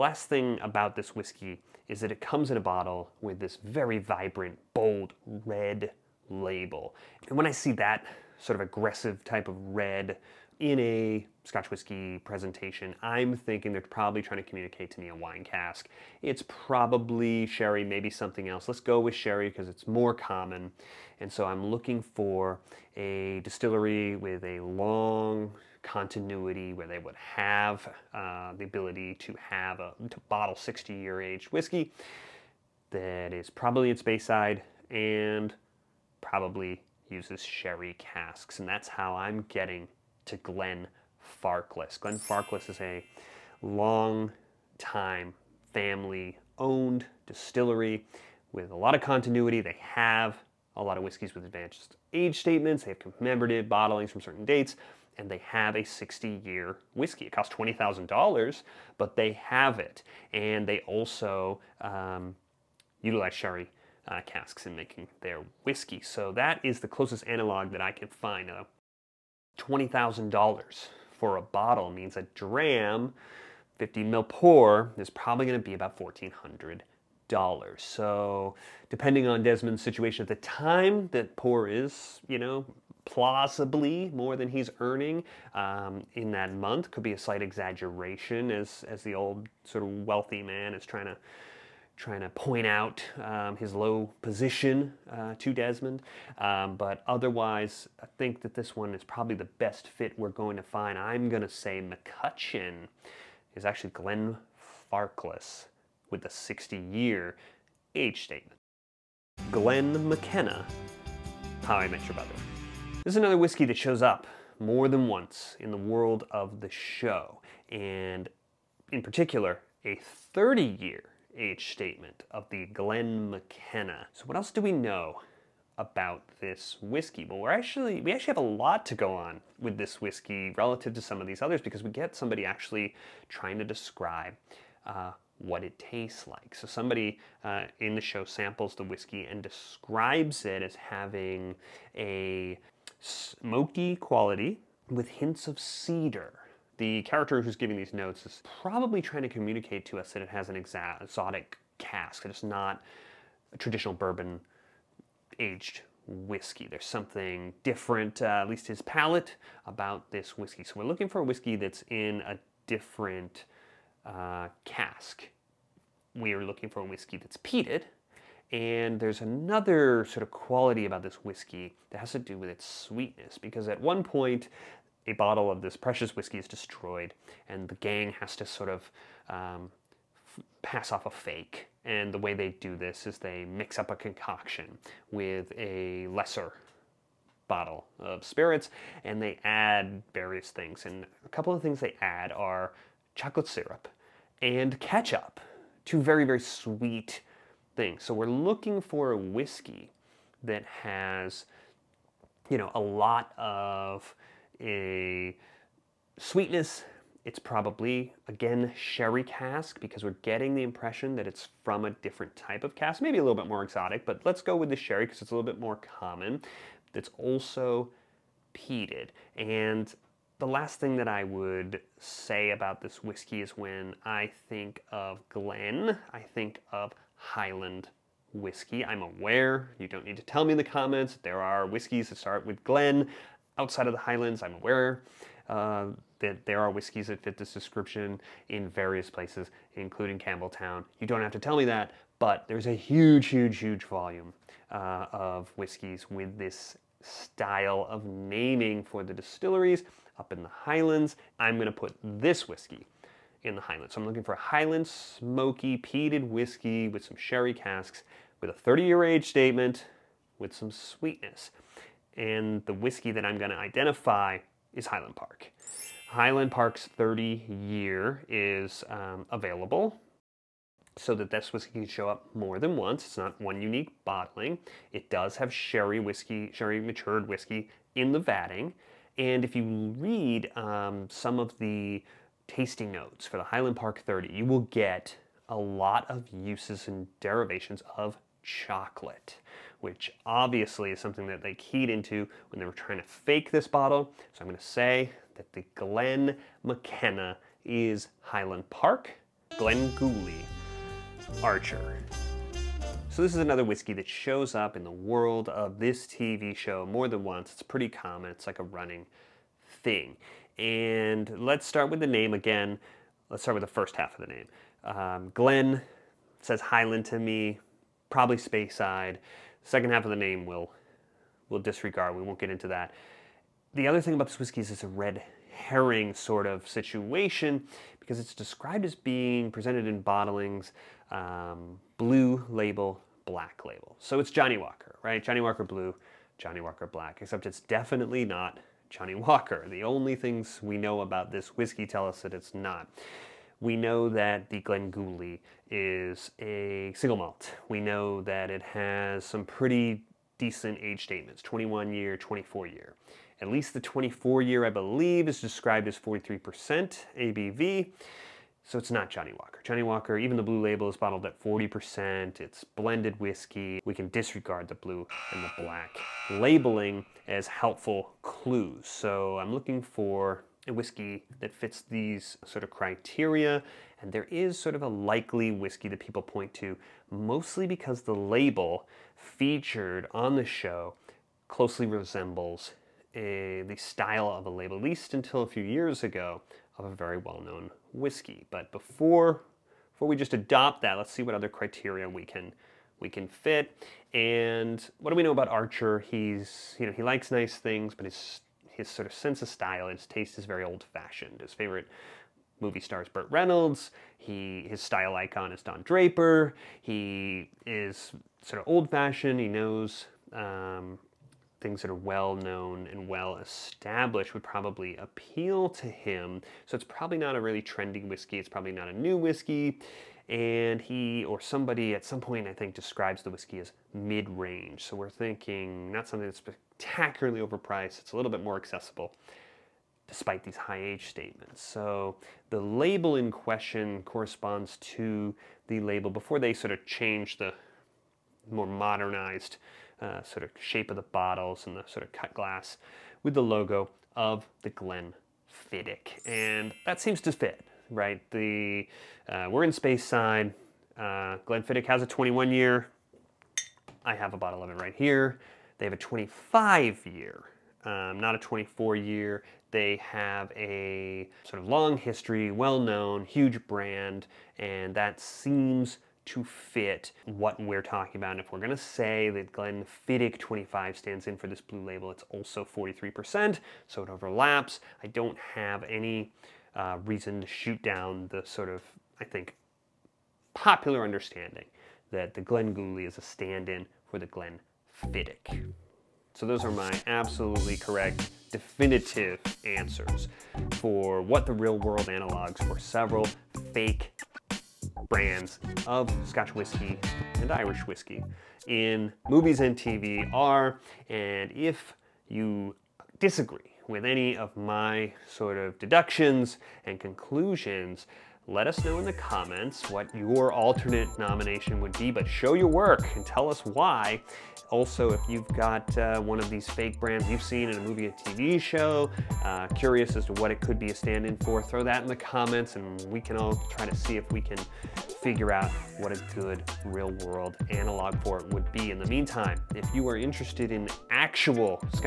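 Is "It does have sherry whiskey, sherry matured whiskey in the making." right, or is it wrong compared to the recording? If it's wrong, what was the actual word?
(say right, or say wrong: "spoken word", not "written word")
wrong: "vatting", not "making".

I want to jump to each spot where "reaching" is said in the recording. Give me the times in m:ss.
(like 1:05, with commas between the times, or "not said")
not said.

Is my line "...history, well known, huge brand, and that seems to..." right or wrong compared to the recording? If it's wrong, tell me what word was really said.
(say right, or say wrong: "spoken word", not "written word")
right.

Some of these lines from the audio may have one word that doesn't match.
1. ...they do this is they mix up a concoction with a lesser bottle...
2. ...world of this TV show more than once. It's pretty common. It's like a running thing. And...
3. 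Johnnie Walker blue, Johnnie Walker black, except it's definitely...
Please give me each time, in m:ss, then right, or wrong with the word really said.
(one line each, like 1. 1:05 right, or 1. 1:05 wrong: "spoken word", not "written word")
1. 3:02 right
2. 5:04 right
3. 5:35 right.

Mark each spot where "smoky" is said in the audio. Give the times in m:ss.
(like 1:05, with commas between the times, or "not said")
2:23, 4:14.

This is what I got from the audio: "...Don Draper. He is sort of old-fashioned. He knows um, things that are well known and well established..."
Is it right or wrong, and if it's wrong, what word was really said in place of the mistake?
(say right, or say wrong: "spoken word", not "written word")
right.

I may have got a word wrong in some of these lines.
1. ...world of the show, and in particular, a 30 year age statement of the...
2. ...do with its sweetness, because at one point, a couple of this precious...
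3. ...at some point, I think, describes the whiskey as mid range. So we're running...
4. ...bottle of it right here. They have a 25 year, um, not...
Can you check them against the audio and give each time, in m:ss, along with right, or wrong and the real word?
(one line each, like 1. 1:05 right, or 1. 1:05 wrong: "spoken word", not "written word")
1. 1:55 right
2. 2:52 wrong: "bottle", not "couple"
3. 7:01 wrong: "thinking", not "running"
4. 7:34 right.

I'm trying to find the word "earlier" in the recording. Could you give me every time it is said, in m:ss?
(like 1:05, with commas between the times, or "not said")
not said.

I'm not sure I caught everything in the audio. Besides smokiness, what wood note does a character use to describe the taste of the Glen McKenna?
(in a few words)
cedar.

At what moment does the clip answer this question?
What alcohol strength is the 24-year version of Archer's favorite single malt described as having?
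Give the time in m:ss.
5:55.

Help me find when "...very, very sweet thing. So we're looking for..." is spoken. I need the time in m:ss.
3:16.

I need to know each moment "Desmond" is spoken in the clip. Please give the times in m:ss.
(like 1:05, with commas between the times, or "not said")
1:19, 1:35.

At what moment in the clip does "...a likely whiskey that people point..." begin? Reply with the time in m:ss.
6:14.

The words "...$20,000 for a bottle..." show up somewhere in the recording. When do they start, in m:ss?
1:09.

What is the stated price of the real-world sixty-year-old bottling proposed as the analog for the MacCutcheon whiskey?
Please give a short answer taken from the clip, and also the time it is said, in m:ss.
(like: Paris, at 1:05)
$20,000, at 0:57.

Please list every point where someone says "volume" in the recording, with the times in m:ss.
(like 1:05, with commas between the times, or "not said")
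4:03.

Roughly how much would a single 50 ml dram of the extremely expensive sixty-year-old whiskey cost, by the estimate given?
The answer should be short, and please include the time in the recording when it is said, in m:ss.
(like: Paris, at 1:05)
$1,400, at 1:15.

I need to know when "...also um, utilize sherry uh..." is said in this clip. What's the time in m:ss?
1:00.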